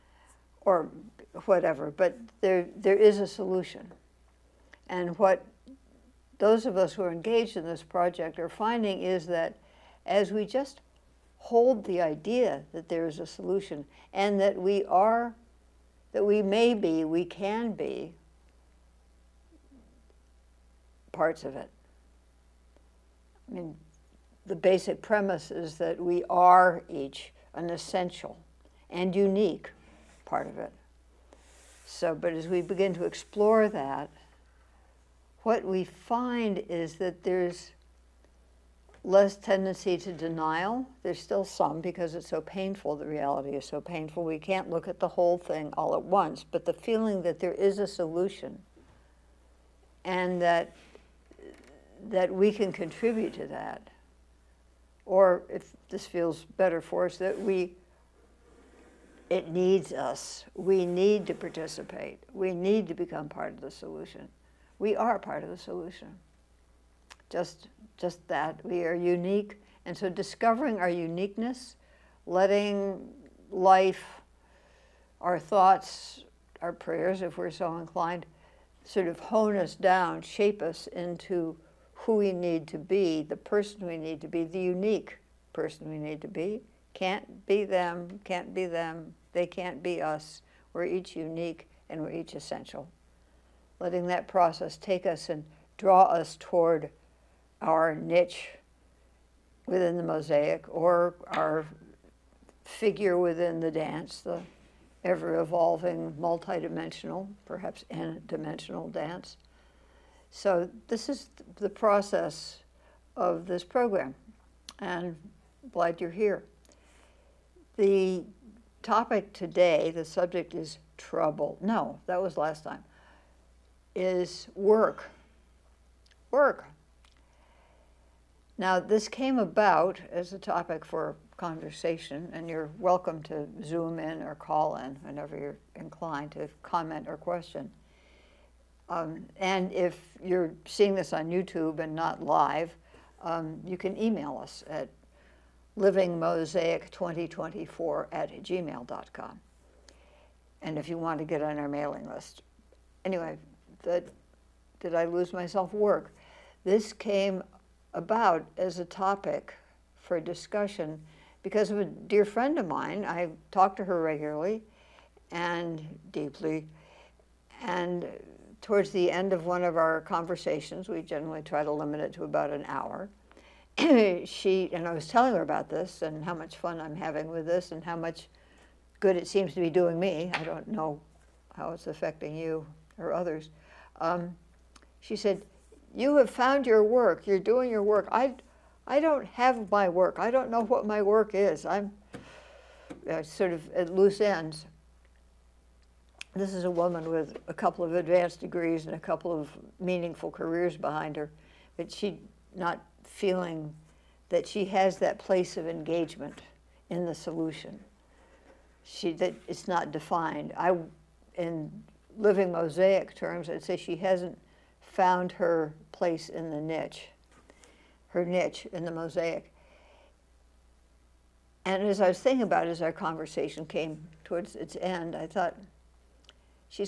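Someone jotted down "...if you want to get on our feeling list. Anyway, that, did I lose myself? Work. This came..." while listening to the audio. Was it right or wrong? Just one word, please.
wrong.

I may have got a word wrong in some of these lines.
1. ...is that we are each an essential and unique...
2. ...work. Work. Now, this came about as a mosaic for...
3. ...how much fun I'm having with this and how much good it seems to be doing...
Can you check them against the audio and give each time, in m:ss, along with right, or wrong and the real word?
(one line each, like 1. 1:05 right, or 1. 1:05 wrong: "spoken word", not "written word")
1. 0:25 right
2. 2:04 wrong: "topic", not "mosaic"
3. 2:56 right.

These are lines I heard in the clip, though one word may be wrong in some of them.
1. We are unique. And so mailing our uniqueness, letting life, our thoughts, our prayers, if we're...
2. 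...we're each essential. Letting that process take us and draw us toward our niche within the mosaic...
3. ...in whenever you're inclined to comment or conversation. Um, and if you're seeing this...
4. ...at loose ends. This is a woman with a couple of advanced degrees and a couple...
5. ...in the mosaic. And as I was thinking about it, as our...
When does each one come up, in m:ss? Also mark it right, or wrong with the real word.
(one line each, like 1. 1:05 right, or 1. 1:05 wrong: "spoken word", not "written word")
1. 1:08 wrong: "discovering", not "mailing"
2. 1:32 right
3. 2:14 wrong: "question", not "conversation"
4. 3:13 right
5. 3:38 right.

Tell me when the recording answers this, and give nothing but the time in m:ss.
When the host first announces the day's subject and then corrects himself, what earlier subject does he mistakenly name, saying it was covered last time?
2:00.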